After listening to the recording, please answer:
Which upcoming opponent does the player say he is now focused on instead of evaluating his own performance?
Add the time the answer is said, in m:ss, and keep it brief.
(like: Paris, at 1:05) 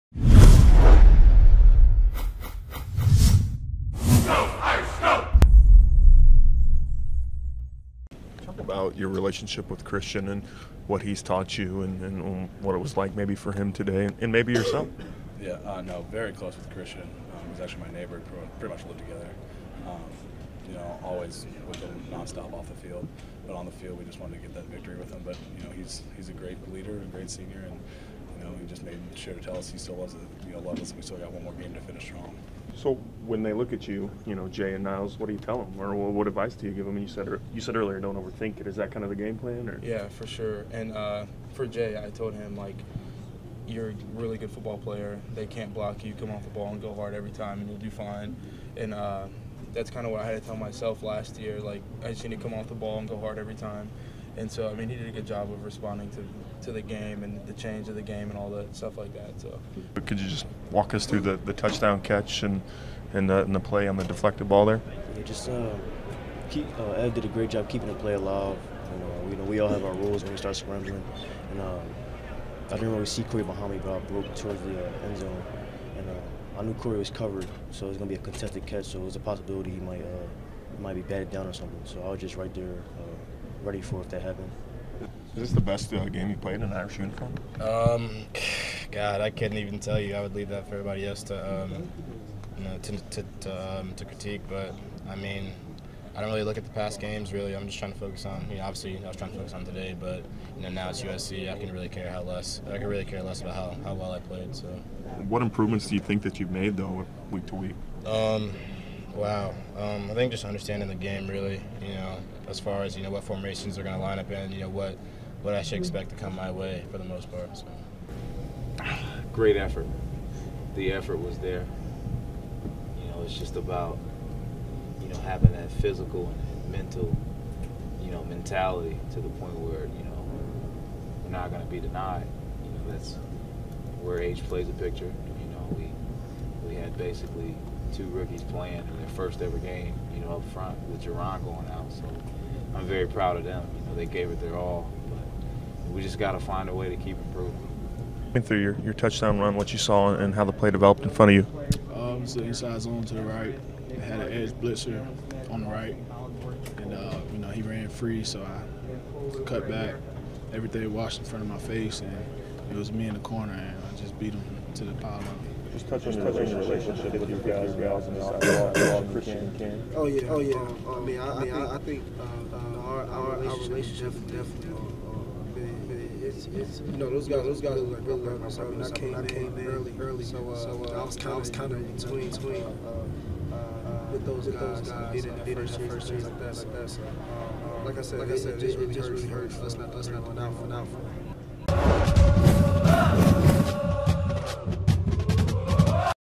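USC, at 1:41.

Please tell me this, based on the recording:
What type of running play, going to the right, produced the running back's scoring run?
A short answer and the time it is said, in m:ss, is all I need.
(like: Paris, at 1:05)
Inside zone, at 2:32.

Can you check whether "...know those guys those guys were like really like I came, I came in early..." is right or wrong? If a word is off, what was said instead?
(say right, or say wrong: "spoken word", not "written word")
right.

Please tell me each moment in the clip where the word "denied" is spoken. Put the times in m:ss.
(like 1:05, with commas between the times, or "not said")
2:11.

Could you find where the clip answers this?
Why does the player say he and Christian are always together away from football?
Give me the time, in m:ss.
0:17.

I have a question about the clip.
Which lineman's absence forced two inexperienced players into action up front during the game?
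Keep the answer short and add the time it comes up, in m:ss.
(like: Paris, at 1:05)
Jarron, at 2:21.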